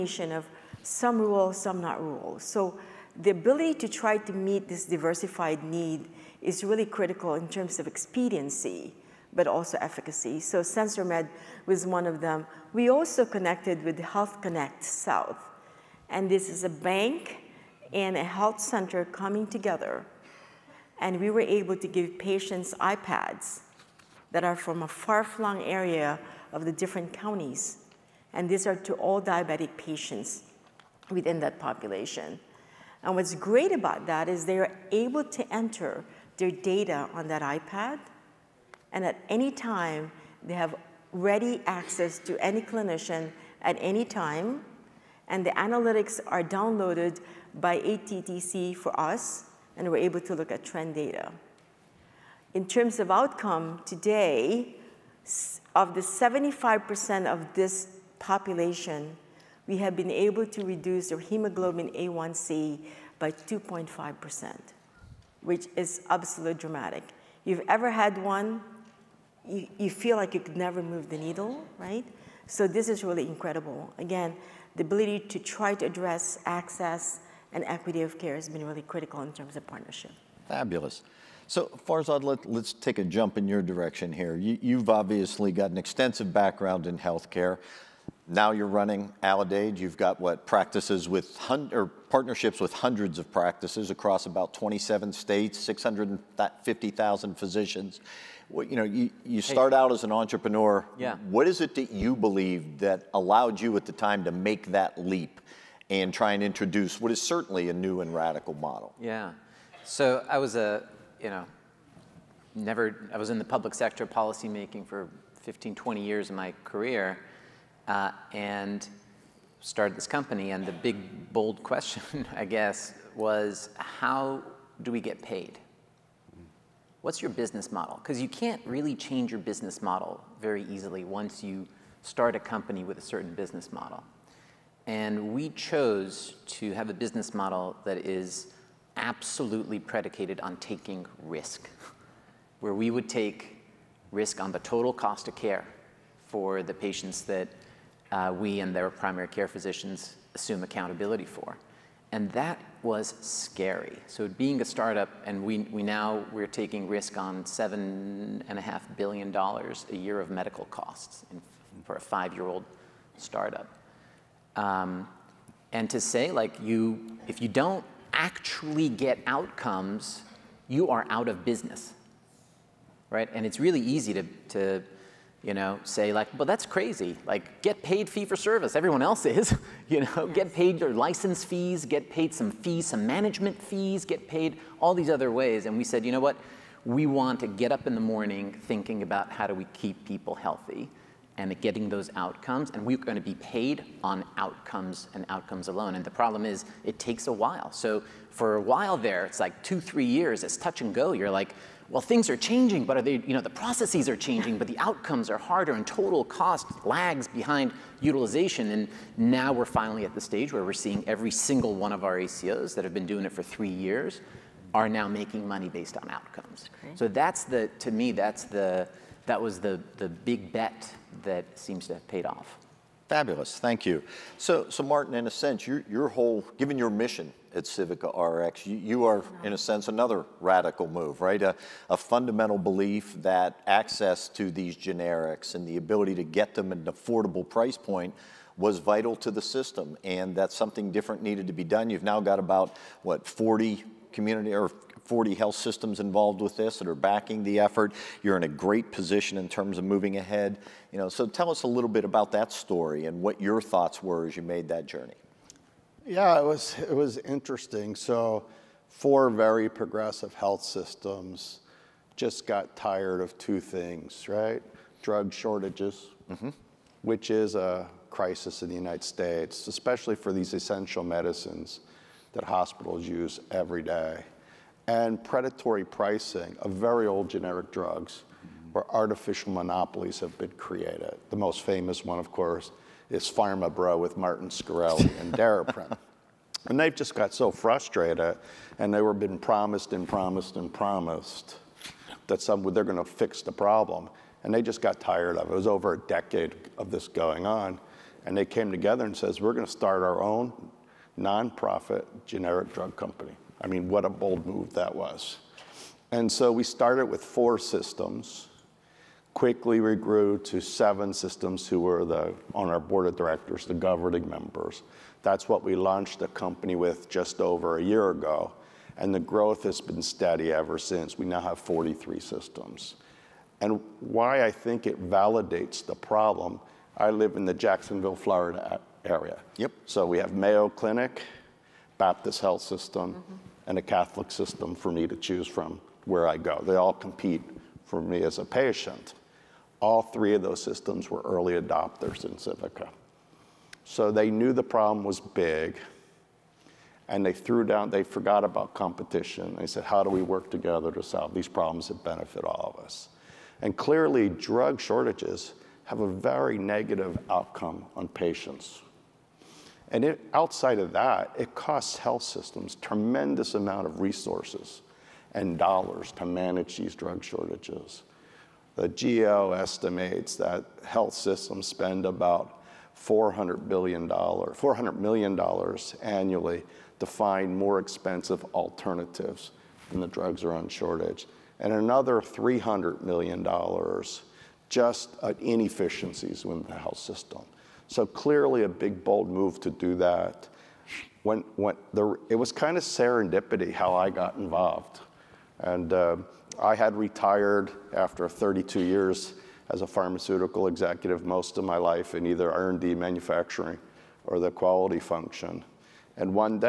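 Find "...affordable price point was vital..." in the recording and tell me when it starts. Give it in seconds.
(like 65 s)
236 s.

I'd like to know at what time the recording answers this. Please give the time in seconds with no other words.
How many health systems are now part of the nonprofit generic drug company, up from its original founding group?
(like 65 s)
321 s.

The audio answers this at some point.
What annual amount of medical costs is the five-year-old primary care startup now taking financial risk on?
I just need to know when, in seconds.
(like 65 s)
157 s.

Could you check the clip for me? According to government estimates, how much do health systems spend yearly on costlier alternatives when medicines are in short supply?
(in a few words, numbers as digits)
$400 million.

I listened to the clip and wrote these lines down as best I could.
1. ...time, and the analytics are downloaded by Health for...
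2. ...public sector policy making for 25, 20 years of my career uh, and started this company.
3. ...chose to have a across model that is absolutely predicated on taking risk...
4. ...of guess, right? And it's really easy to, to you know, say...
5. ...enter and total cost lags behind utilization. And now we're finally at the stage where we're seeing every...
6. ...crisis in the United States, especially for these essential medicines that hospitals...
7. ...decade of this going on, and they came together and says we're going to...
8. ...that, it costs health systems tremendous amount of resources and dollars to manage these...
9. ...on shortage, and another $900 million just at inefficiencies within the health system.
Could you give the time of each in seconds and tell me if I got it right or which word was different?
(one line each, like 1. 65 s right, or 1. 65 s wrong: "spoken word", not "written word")
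1. 44 s wrong: "ATDC", not "Health"
2. 113 s wrong: "15", not "25"
3. 135 s wrong: "business", not "across"
4. 171 s wrong: "business", not "guess"
5. 205 s wrong: "harder", not "enter"
6. 268 s right
7. 295 s right
8. 360 s right
9. 380 s wrong: "300", not "900".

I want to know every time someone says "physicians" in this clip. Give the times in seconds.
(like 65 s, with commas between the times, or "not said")
97 s, 149 s.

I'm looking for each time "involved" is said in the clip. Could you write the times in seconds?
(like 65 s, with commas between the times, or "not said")
246 s, 394 s.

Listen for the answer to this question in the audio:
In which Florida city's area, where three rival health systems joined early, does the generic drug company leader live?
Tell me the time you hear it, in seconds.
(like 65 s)
327 s.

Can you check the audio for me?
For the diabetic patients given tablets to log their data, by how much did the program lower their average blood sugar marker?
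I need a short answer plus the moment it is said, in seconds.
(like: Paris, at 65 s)
2.5%, at 63 s.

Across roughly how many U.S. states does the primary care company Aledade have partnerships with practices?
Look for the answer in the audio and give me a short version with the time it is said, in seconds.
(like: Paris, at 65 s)
27, at 94 s.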